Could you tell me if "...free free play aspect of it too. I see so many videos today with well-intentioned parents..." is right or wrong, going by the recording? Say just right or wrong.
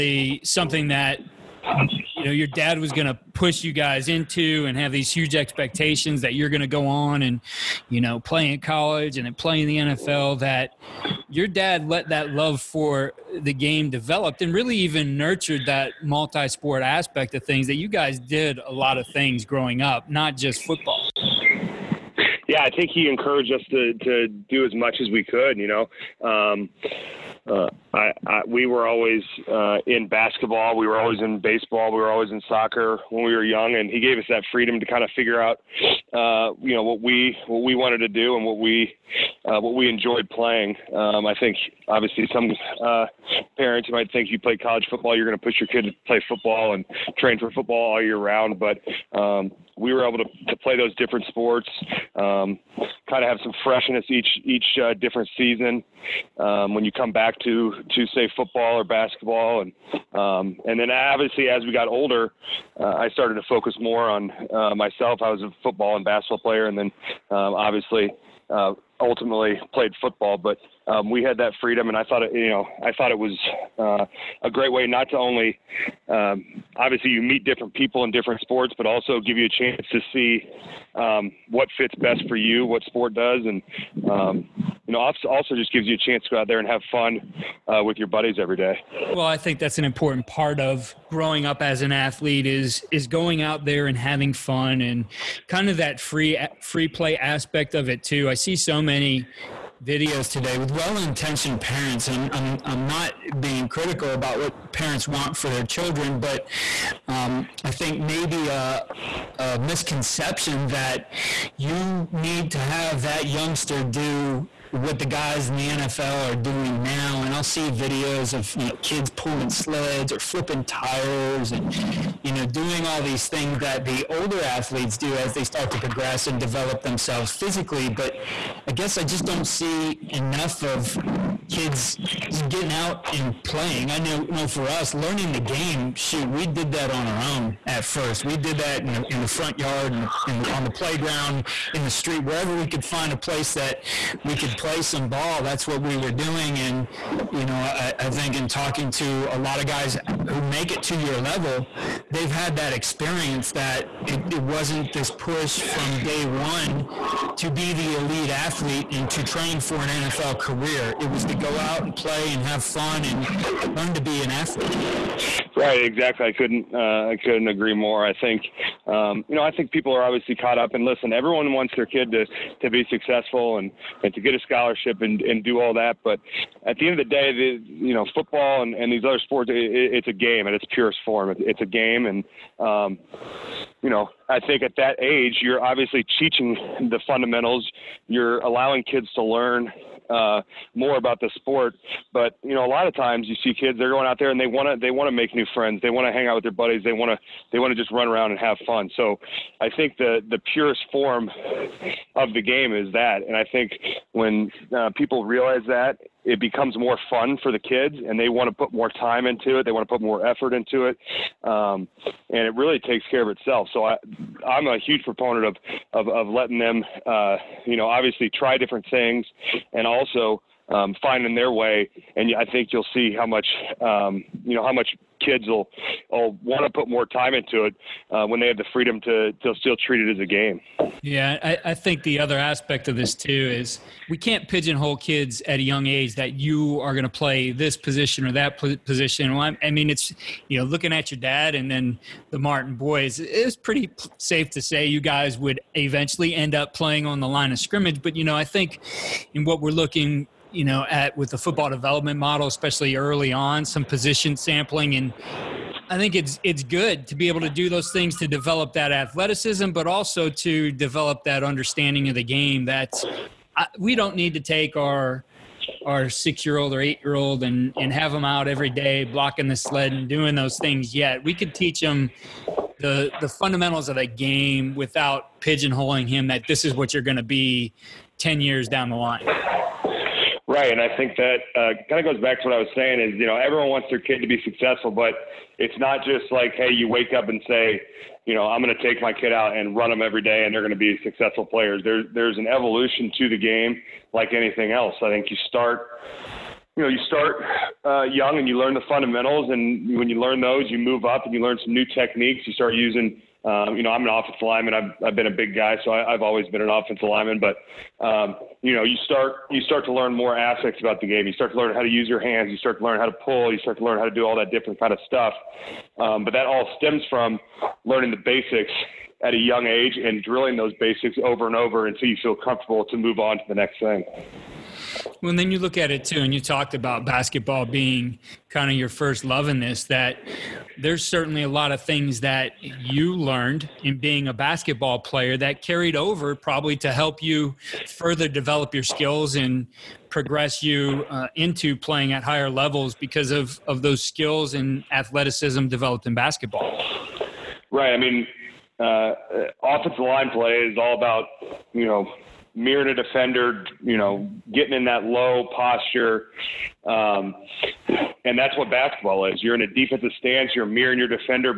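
right.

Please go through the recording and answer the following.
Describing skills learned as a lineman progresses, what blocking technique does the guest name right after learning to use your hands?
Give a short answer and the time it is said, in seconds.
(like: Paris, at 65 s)
Pulling, at 313 s.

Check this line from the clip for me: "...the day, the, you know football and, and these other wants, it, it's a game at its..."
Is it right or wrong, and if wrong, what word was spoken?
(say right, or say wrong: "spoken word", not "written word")
wrong: "sports", not "wants".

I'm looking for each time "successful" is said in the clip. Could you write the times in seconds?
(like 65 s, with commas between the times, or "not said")
172 s, 284 s, 291 s.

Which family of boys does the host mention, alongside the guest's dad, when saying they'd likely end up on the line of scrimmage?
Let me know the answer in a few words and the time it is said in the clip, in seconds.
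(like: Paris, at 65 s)
The Martin boys, at 242 s.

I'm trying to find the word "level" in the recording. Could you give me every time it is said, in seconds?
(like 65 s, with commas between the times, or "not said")
151 s, 342 s.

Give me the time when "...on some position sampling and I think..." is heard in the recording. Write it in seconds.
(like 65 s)
253 s.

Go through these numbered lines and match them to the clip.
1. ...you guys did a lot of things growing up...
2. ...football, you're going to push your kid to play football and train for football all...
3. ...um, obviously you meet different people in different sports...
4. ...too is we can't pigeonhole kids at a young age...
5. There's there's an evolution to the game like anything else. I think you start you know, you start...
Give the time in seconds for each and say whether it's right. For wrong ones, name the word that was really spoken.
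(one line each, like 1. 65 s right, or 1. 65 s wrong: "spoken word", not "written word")
1. 17 s right
2. 44 s right
3. 76 s right
4. 233 s right
5. 291 s right.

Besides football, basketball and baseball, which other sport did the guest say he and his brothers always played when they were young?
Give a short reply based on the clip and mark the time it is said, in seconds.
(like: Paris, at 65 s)
Soccer, at 32 s.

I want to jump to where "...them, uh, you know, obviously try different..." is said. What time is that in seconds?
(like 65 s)
216 s.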